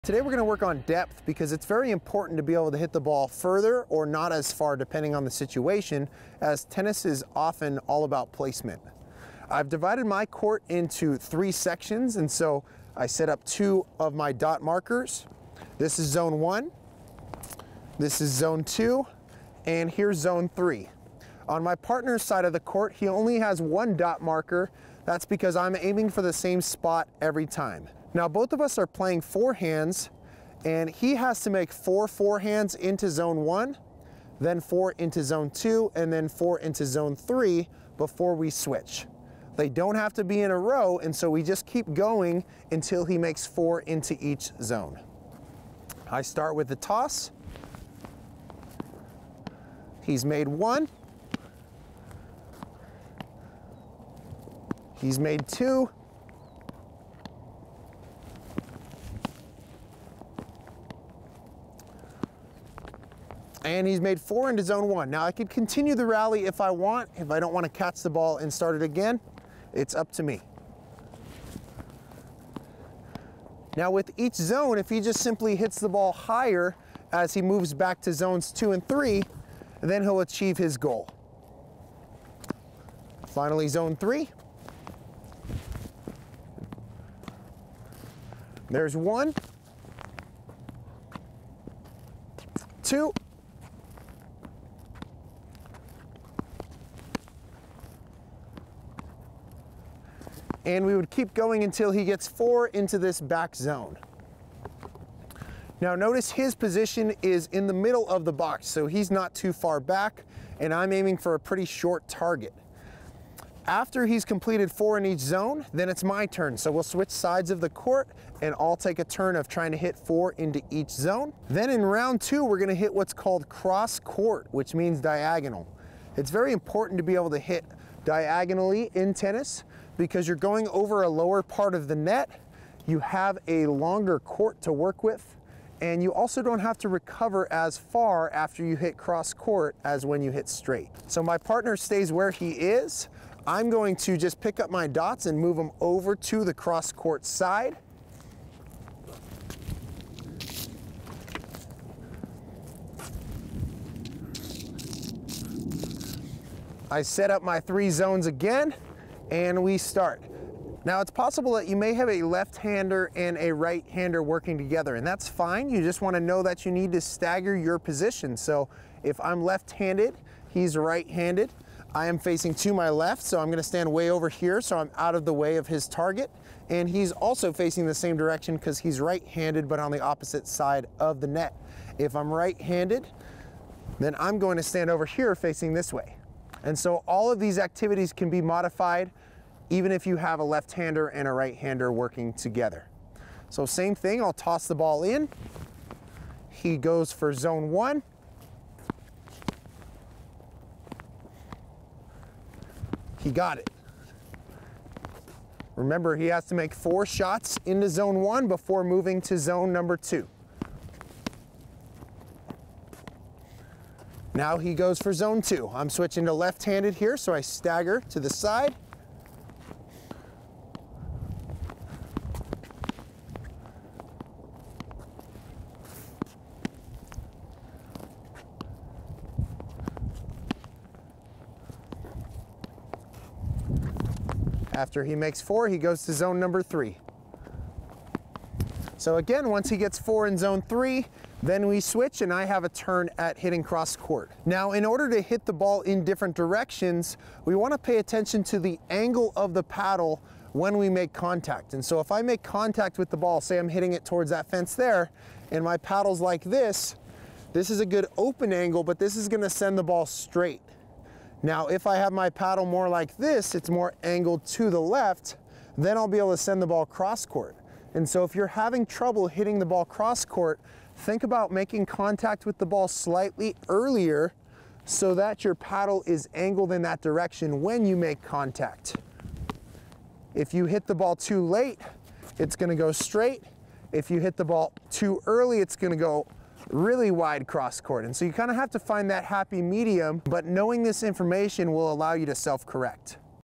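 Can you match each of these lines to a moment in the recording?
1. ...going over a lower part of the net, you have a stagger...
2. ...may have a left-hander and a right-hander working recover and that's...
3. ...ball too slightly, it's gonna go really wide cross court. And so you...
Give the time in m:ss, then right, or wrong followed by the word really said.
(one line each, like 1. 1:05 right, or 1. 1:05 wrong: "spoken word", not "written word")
1. 2:10 wrong: "longer", not "stagger"
2. 2:41 wrong: "together", not "recover"
3. 4:44 wrong: "early", not "slightly".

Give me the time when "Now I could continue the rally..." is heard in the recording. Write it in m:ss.
1:05.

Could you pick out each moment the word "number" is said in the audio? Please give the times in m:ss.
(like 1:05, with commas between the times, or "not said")
3:29, 3:56.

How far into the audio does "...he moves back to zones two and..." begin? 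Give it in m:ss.
1:17.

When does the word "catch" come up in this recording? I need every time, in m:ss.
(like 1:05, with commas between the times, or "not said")
1:07.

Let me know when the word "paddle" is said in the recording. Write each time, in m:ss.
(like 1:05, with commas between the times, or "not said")
4:09, 4:15, 4:22, 4:35.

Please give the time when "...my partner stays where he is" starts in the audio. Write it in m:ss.
2:21.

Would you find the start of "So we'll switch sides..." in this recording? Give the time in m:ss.
1:56.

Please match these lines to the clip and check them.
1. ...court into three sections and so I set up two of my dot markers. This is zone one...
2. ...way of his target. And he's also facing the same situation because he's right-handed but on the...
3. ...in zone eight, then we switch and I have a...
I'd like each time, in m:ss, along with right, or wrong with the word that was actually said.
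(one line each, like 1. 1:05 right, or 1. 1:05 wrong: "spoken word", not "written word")
1. 0:10 right
2. 2:55 wrong: "direction", not "situation"
3. 4:00 wrong: "three", not "eight".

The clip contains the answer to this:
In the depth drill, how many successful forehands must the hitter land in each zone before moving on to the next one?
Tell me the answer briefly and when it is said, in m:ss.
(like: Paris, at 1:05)
4, at 0:31.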